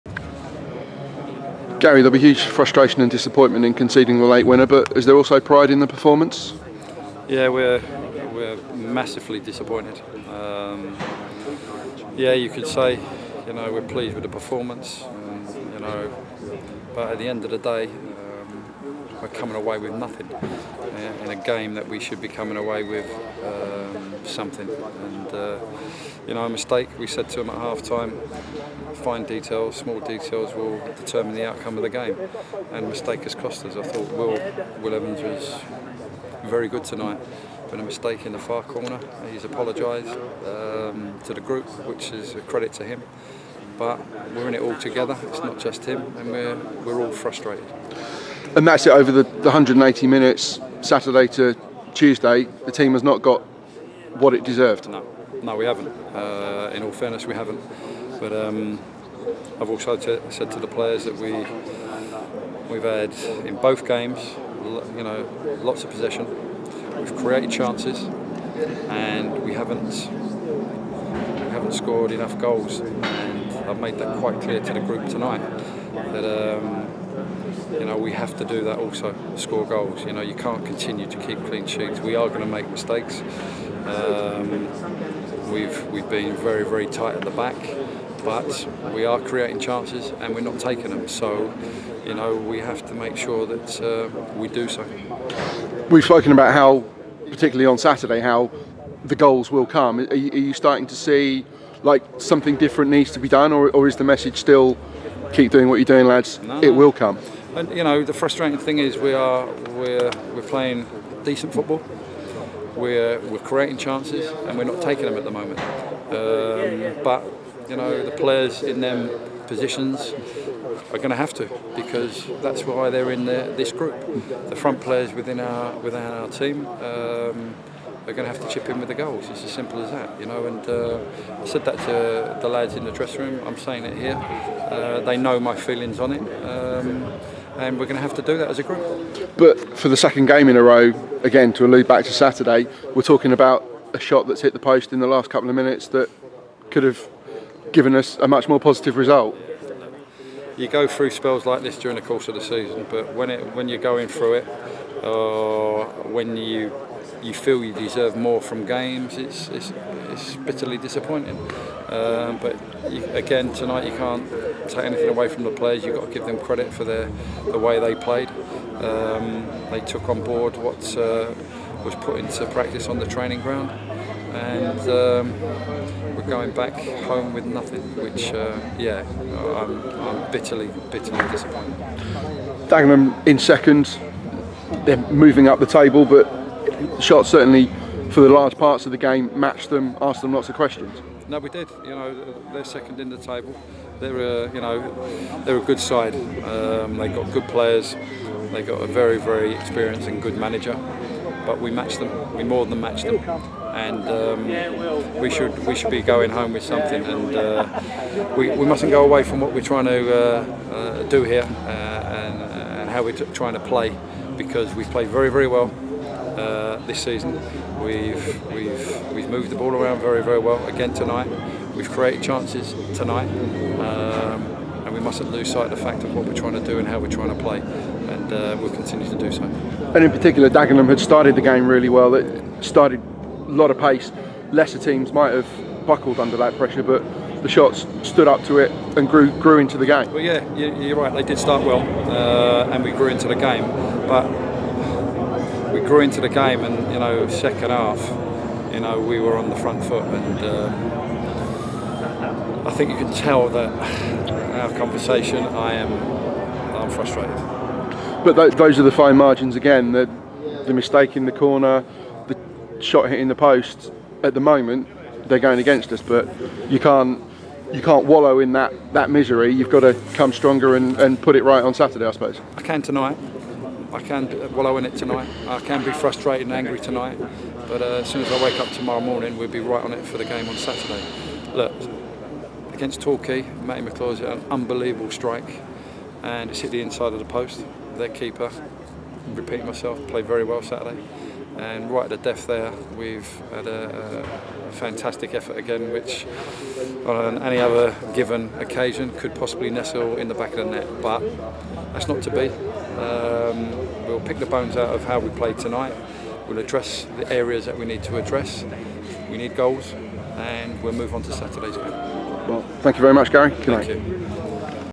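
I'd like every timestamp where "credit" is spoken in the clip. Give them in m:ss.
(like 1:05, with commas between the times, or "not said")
0:42, 2:46.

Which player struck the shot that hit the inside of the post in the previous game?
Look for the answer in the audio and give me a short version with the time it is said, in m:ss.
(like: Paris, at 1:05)
Matty McClaws, at 4:43.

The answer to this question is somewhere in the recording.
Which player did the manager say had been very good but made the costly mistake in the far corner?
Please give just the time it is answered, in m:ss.
0:34.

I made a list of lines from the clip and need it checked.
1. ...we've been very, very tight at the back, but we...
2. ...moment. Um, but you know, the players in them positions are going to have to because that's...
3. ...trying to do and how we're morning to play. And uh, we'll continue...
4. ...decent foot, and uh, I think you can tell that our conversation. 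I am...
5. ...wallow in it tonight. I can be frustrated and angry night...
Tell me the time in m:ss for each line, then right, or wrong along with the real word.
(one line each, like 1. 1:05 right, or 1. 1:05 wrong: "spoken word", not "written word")
1. 1:25 right
2. 1:55 right
3. 3:46 wrong: "trying", not "morning"
4. 4:09 wrong: "front", not "decent"
5. 4:34 wrong: "tonight", not "night".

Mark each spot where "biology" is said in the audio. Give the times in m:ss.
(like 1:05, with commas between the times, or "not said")
not said.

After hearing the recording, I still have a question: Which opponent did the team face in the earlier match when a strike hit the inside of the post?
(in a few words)
Torquay.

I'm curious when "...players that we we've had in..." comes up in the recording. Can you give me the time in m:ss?
1:00.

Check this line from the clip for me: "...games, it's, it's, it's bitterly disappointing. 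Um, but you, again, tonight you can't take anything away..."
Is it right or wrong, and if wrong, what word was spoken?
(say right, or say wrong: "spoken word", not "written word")
right.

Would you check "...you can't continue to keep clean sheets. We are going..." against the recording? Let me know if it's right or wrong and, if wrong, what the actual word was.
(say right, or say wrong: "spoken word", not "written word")
right.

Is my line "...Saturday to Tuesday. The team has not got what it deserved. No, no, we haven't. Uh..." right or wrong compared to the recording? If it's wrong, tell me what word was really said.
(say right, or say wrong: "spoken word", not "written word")
right.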